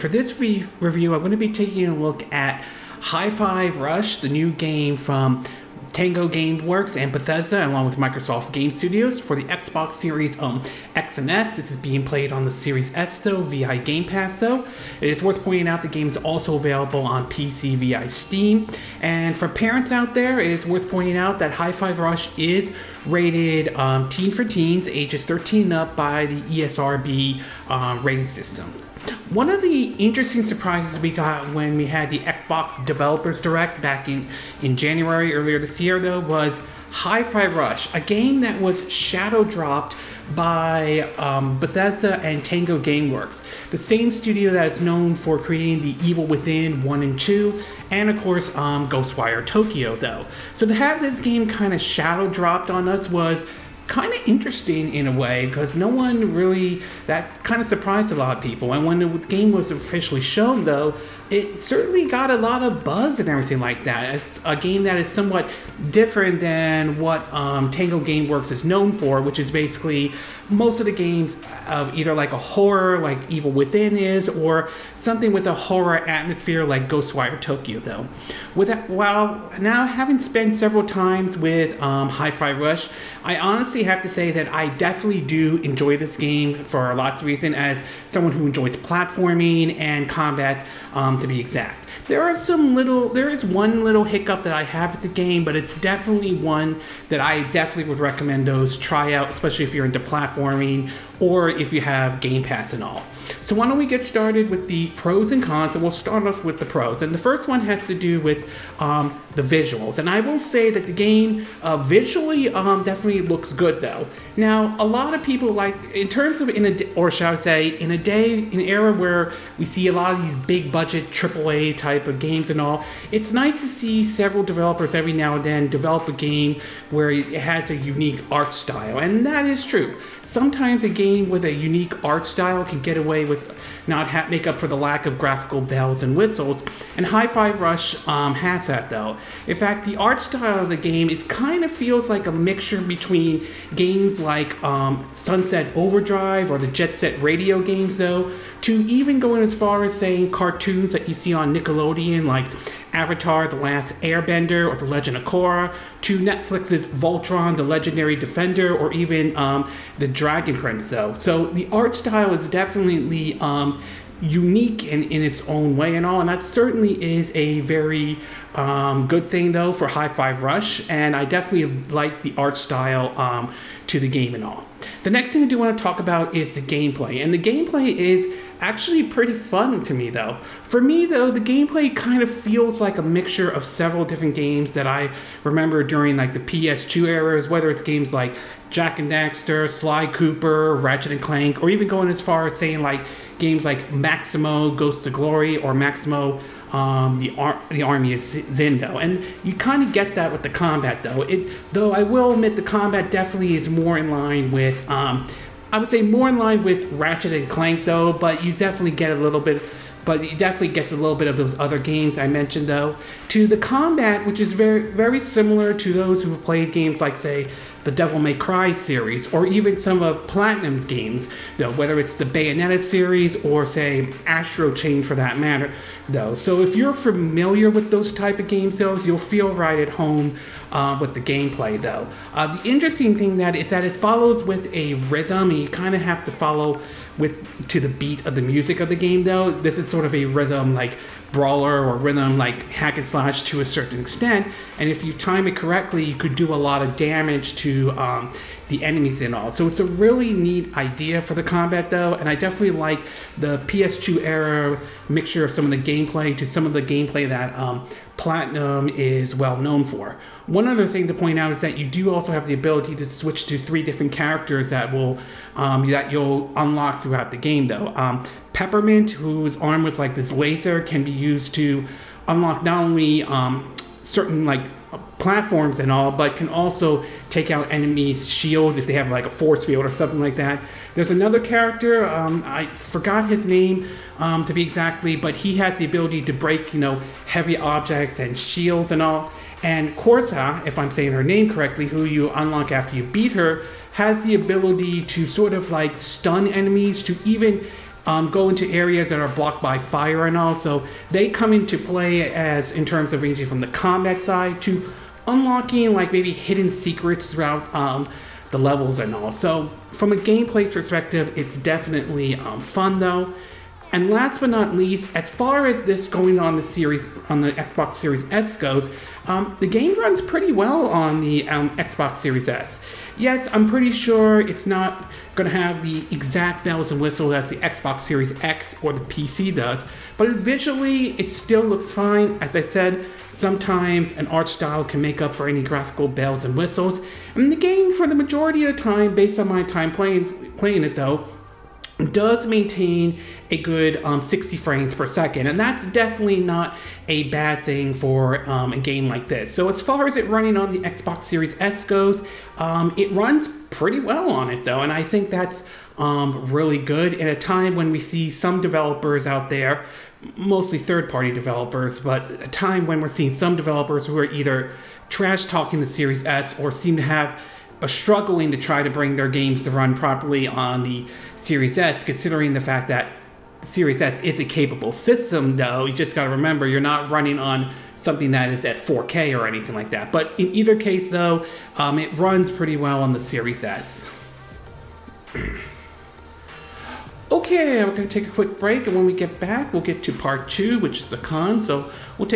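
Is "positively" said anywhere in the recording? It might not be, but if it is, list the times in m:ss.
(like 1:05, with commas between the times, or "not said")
not said.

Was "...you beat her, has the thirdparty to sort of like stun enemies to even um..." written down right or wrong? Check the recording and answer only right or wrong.
wrong.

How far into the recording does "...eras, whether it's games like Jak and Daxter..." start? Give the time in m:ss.
3:07.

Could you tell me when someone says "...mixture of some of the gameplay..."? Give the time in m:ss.
4:15.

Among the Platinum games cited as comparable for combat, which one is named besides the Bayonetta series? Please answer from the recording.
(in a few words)
Astral Chain.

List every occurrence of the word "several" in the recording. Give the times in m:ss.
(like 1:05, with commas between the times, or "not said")
1:20, 2:04, 3:03.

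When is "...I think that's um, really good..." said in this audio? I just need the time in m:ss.
5:54.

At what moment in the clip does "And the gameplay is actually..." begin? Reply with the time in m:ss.
2:57.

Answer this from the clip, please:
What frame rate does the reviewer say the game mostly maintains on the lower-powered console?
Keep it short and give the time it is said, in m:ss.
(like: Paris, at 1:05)
60 frames per second, at 5:44.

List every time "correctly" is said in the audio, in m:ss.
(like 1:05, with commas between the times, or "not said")
4:05, 4:51.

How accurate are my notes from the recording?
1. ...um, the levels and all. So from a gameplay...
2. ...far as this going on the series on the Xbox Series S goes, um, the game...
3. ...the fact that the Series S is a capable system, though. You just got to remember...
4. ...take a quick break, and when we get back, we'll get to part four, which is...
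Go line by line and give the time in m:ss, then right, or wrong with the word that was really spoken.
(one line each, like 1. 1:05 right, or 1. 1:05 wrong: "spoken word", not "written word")
1. 5:07 right
2. 5:15 right
3. 6:12 right
4. 6:28 wrong: "two", not "four".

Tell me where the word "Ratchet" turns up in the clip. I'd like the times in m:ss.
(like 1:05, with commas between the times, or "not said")
3:10, 3:26.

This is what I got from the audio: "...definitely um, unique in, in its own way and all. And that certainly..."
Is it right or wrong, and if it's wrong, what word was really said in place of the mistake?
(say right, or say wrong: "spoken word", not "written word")
right.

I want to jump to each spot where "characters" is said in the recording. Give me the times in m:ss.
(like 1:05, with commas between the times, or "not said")
4:24, 4:41.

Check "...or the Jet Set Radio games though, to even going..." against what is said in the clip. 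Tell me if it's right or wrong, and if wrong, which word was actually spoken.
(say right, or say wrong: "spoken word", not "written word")
right.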